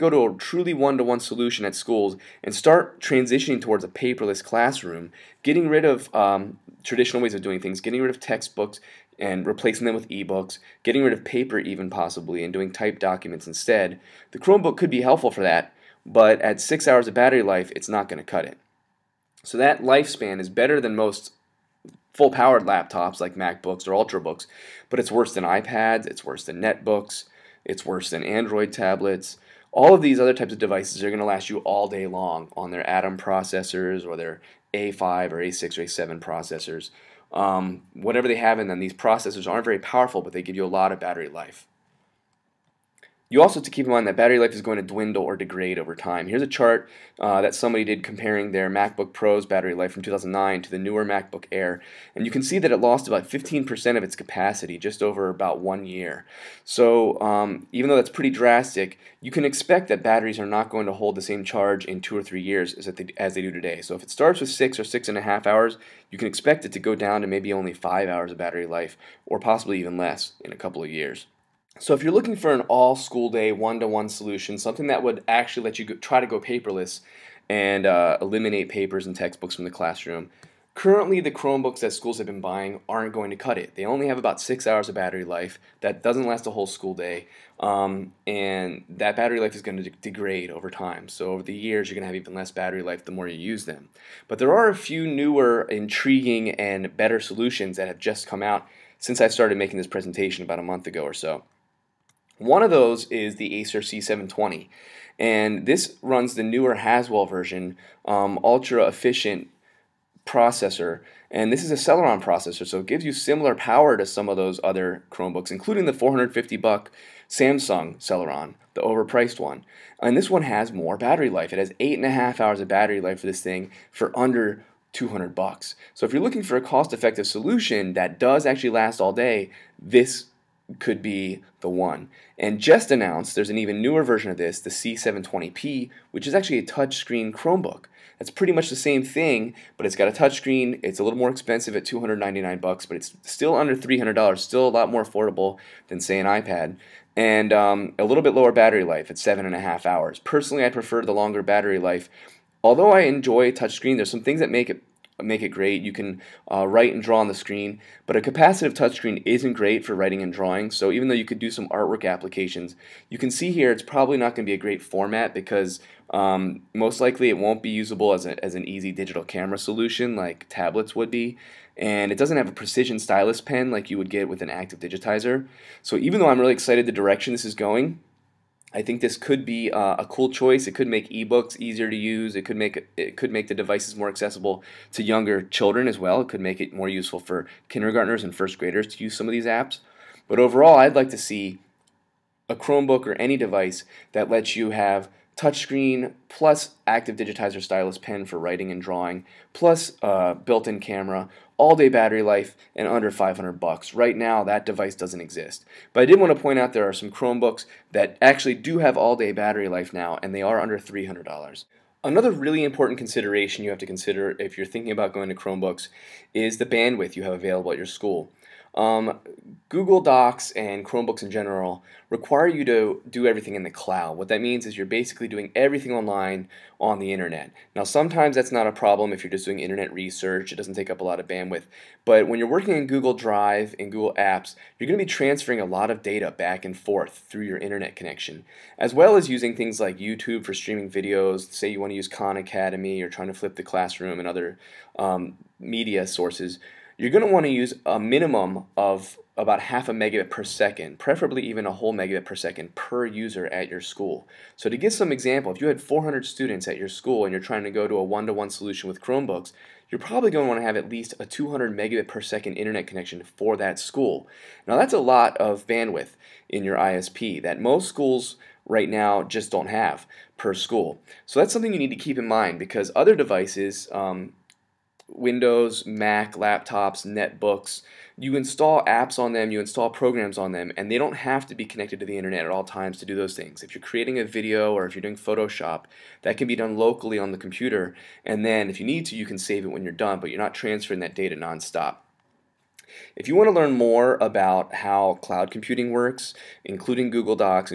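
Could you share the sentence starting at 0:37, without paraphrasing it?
Um, whatever they have in them, these processors aren't very powerful, but they give you a lot of battery life.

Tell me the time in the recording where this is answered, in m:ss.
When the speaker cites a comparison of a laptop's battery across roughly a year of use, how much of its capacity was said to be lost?
0:53.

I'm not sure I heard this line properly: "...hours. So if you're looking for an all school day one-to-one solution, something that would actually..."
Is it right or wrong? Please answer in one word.
wrong.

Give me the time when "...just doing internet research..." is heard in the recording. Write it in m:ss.
3:49.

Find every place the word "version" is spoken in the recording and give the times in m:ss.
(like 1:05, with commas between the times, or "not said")
1:47, 2:14.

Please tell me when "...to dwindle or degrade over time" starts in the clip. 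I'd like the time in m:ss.
0:44.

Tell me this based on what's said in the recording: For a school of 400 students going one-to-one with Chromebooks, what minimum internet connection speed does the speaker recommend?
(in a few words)
200 megabits per second.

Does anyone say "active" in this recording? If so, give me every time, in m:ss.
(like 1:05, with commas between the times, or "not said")
2:54, 3:16.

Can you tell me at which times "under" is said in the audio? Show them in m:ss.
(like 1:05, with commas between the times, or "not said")
2:04, 2:23, 3:22, 3:30.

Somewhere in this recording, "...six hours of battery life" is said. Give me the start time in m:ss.
1:24.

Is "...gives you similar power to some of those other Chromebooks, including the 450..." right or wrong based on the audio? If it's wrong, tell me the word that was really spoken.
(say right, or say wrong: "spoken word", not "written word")
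right.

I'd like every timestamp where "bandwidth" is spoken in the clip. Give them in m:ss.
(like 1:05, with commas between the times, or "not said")
3:36, 3:51, 4:25.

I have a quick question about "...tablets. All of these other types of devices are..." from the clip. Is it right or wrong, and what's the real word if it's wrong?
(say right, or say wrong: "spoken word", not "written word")
right.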